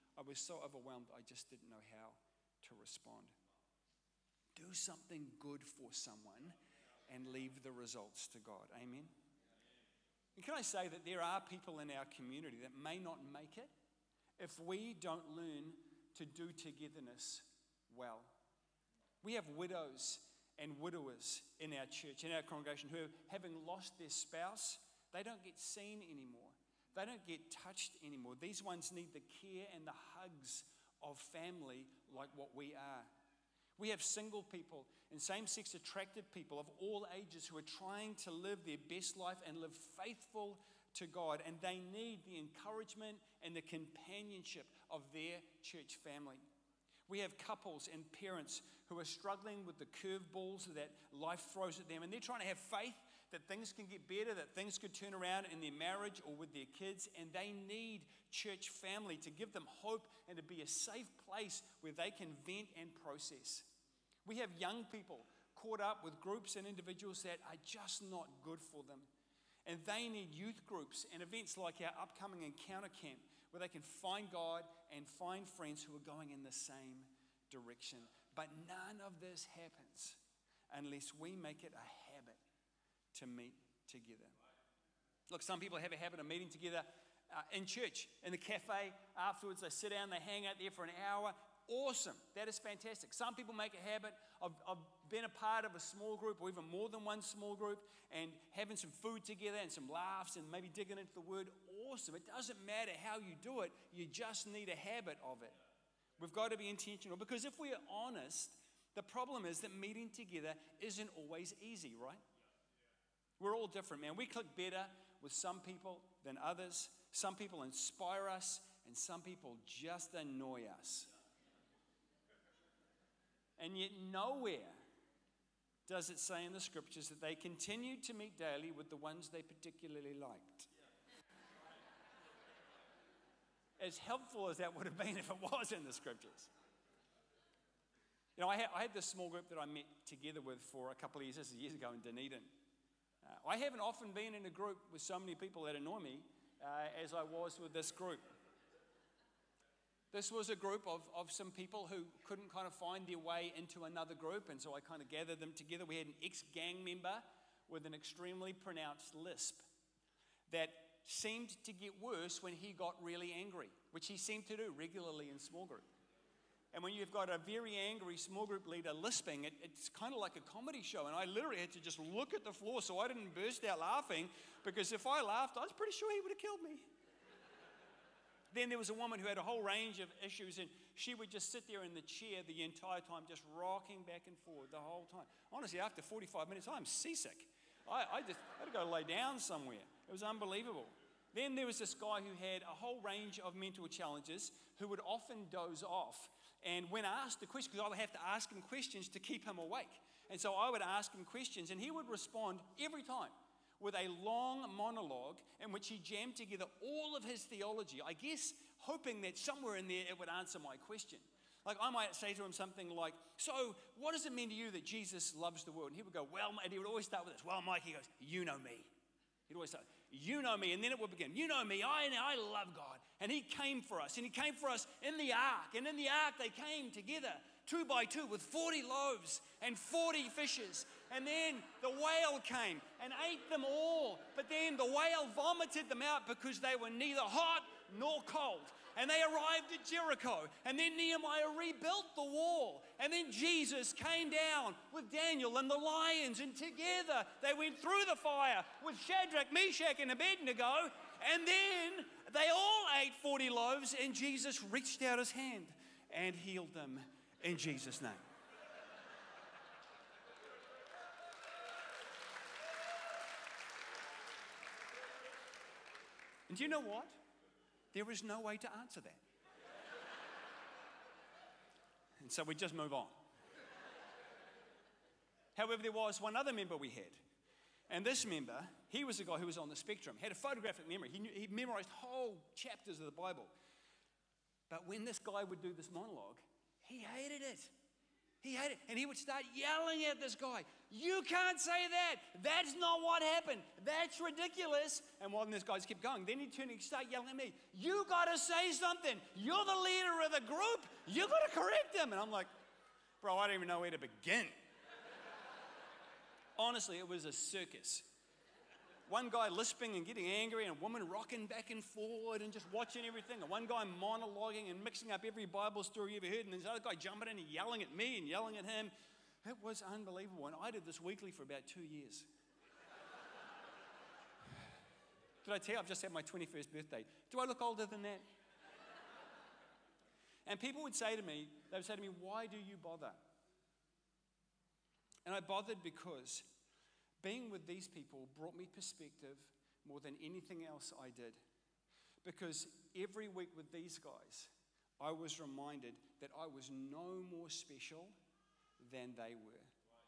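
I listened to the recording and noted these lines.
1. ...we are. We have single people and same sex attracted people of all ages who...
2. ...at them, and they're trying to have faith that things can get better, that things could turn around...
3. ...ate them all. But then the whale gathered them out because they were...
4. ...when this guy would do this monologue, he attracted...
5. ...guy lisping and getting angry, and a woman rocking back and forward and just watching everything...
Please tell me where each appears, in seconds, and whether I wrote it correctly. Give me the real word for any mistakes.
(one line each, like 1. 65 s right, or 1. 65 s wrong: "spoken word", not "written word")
1. 32 s right
2. 51 s right
3. 233 s wrong: "vomited", not "gathered"
4. 284 s wrong: "hated", not "attracted"
5. 309 s right.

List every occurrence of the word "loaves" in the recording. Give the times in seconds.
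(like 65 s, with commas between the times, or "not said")
228 s, 253 s.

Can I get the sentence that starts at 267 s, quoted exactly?
There is no way to answer that.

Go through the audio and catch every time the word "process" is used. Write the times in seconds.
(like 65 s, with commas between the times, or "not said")
62 s.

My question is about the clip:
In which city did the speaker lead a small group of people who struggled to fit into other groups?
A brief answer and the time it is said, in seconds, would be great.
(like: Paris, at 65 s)
Dunedin, at 142 s.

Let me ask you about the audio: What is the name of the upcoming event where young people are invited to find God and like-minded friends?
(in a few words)
Encounter camp.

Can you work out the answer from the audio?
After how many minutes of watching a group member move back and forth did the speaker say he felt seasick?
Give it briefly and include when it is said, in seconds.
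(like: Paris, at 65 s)
45, at 186 s.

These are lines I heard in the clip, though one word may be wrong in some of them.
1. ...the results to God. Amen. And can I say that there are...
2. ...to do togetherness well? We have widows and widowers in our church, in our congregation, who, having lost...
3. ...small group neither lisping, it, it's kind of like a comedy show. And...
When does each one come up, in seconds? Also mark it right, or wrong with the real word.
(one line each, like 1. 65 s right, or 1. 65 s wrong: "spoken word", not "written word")
1. 7 s right
2. 16 s right
3. 168 s wrong: "leader", not "neither".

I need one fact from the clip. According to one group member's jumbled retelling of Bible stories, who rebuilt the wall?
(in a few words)
Nehemiah.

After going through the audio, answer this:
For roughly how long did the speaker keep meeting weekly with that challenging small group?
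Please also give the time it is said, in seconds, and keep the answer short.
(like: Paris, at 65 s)
About 2 years, at 321 s.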